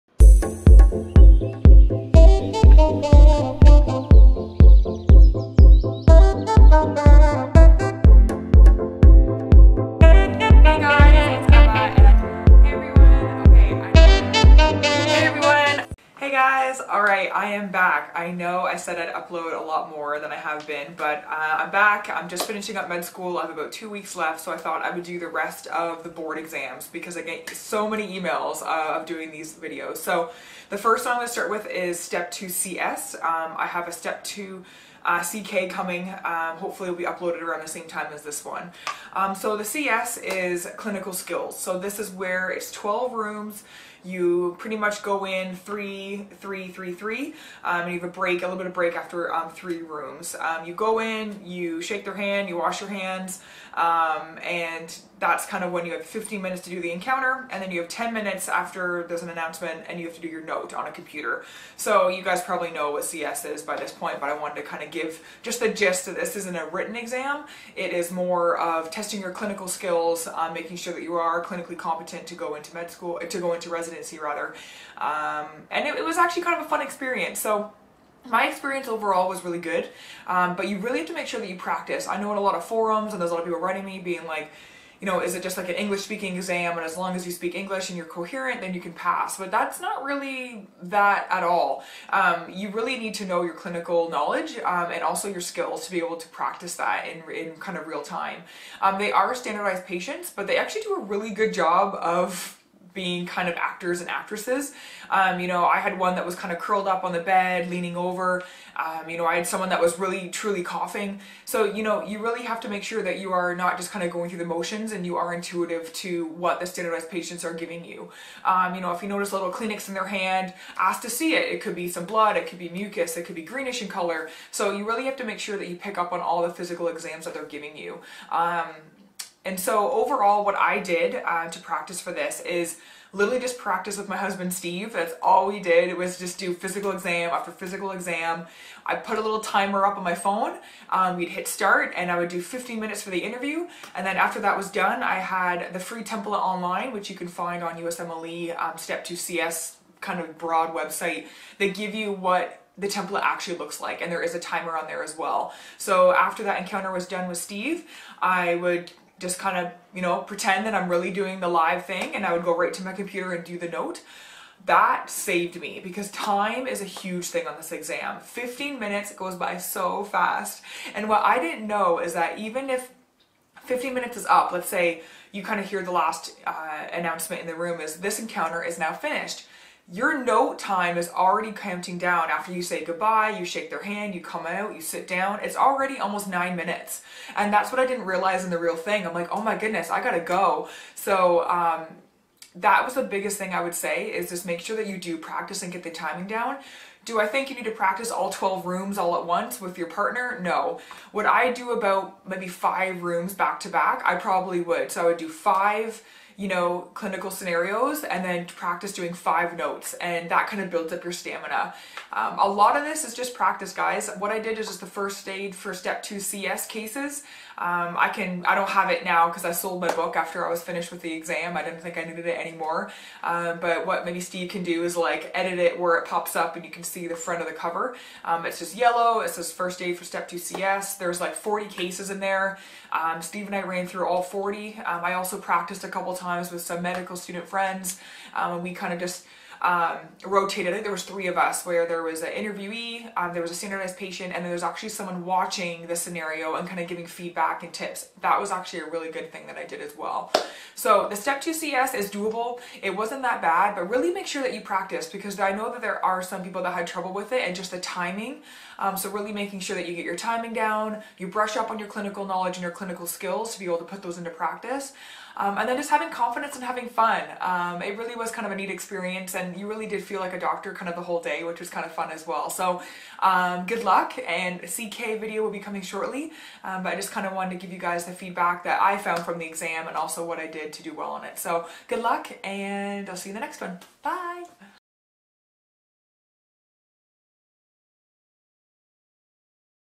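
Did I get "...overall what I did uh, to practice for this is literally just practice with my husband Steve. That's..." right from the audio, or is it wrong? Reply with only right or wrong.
right.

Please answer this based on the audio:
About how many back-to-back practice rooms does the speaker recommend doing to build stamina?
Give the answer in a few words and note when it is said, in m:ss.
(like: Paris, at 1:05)
5, at 3:22.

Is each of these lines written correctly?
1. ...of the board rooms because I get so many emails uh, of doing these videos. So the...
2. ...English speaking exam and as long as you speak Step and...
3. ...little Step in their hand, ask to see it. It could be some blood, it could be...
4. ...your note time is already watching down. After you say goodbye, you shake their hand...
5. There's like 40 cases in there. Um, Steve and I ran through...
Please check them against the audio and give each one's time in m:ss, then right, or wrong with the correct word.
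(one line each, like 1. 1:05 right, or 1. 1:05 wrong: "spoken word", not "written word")
1. 0:25 wrong: "exams", not "rooms"
2. 1:25 wrong: "English", not "Step"
3. 1:59 wrong: "Kleenex", not "Step"
4. 2:59 wrong: "counting", not "watching"
5. 3:50 right.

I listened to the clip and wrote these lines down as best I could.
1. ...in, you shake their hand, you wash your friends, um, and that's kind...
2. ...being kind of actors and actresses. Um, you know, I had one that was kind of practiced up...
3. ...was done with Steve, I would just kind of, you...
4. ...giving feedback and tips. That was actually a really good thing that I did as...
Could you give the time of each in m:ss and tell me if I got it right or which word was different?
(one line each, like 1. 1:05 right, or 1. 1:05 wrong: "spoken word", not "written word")
1. 0:50 wrong: "hands", not "friends"
2. 1:42 wrong: "curled", not "practiced"
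3. 2:36 right
4. 4:06 right.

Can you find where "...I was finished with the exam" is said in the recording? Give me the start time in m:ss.
3:40.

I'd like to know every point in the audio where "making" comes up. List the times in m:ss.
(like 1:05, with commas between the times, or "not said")
1:10, 4:19.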